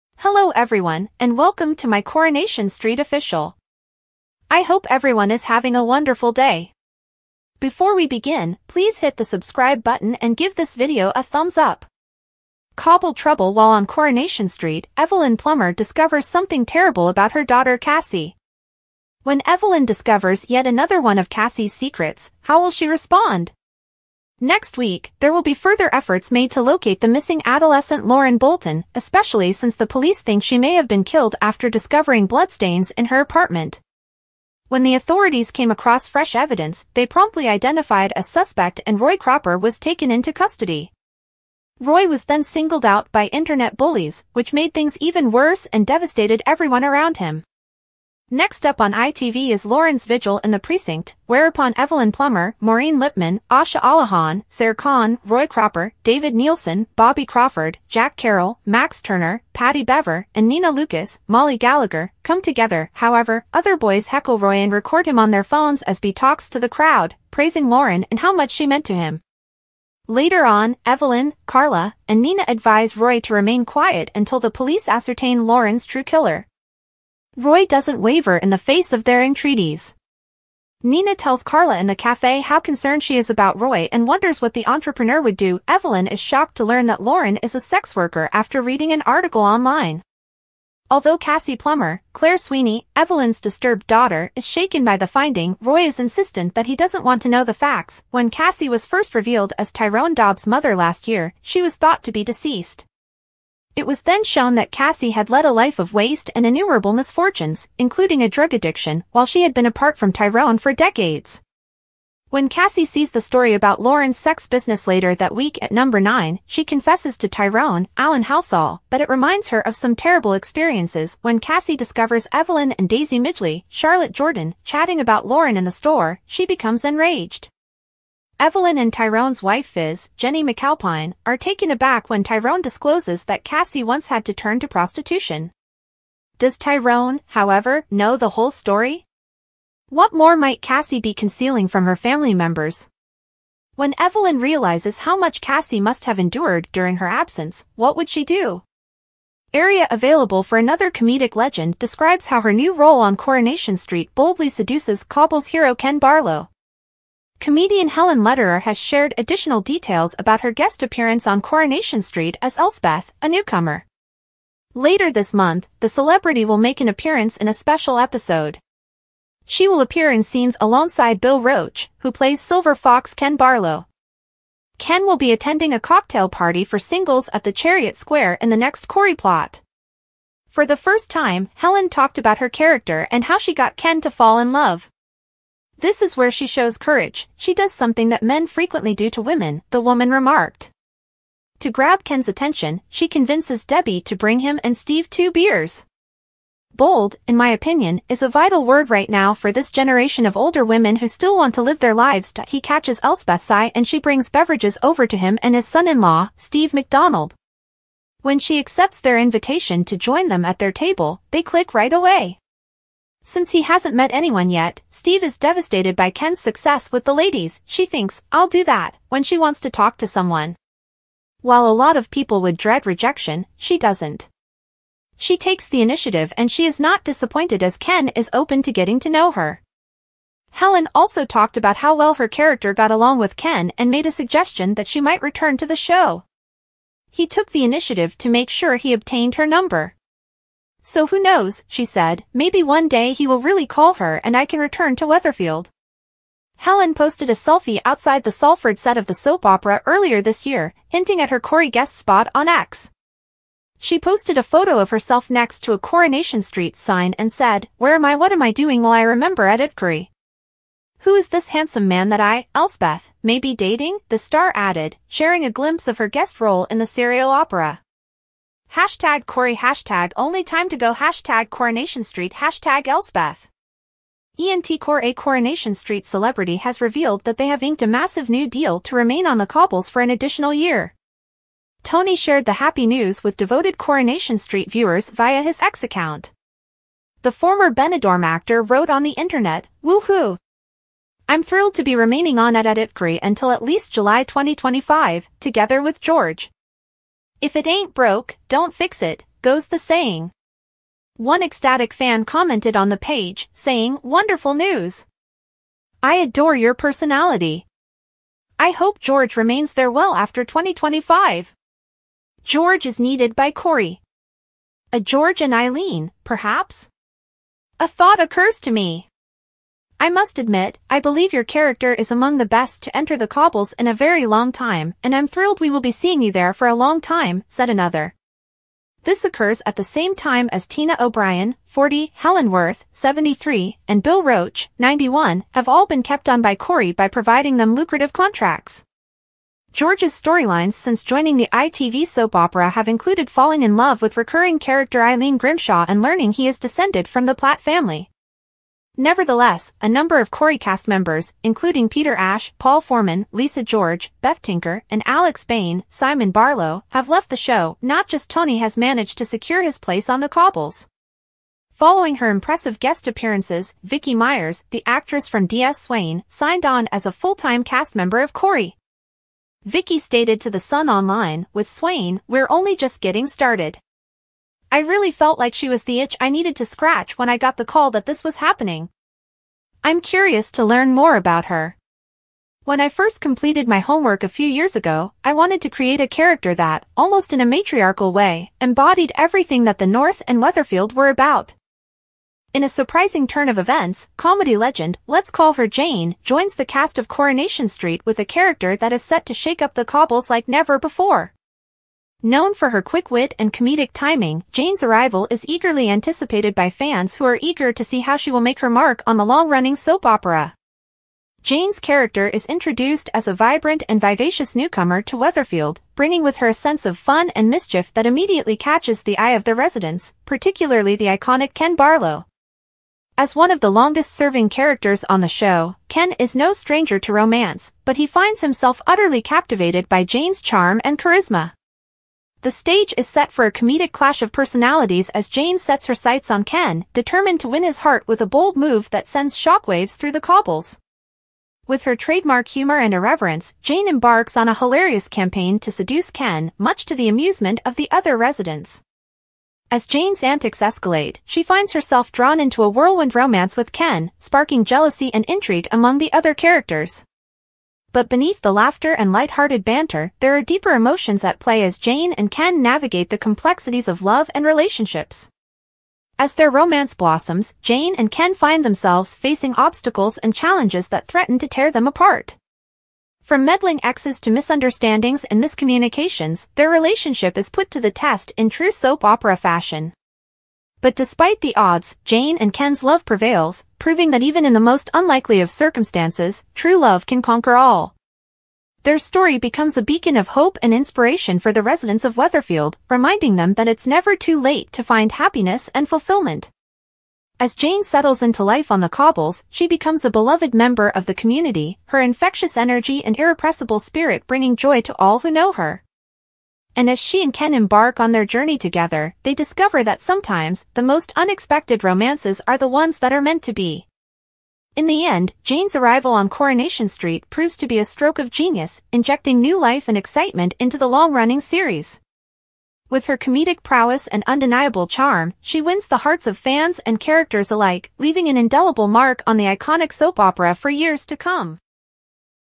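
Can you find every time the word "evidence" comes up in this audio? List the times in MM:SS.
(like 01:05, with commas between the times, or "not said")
00:36.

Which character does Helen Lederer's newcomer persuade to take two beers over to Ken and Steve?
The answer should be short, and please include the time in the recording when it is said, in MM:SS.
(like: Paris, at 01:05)
Debbie, at 03:13.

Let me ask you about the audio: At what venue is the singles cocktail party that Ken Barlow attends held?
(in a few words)
Chariot Square.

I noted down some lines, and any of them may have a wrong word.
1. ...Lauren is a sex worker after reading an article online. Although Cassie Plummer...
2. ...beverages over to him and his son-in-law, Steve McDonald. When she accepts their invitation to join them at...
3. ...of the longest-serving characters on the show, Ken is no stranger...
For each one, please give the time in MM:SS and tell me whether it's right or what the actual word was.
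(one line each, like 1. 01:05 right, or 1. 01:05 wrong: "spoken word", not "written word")
1. 01:27 right
2. 03:24 right
3. 07:03 right.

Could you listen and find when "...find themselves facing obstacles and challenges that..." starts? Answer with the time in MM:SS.
07:48.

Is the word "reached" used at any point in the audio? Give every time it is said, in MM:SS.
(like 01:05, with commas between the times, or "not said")
not said.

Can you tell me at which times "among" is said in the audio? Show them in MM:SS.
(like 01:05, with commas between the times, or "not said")
05:22, 07:35.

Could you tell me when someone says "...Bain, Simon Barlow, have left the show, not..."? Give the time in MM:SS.
05:55.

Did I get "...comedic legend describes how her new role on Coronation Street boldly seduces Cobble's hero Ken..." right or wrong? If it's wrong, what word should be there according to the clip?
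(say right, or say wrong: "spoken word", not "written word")
right.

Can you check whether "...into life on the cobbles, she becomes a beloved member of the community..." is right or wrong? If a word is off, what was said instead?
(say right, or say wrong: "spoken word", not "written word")
right.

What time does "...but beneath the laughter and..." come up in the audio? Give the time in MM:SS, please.
07:37.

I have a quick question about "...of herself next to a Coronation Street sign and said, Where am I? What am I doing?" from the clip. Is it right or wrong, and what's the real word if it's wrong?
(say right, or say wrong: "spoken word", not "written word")
right.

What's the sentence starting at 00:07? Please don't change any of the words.
Before we begin, please hit the subscribe button and give this video a thumbs up.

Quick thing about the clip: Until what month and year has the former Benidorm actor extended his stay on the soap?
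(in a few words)
July 2025.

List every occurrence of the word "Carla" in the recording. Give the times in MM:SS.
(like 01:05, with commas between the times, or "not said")
01:11, 01:21.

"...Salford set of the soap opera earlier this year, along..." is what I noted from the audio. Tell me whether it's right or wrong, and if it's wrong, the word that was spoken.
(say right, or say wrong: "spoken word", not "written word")
wrong: "hinting", not "along".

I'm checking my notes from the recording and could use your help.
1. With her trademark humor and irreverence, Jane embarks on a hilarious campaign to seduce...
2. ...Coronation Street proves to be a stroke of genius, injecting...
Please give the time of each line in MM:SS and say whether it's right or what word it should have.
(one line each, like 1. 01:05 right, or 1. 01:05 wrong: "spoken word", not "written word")
1. 07:21 right
2. 08:36 right.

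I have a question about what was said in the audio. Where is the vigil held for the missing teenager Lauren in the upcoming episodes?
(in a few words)
the Precinct.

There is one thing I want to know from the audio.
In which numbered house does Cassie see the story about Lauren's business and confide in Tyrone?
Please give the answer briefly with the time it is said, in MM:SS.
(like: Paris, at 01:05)
number 9, at 01:55.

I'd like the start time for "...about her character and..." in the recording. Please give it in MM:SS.
03:02.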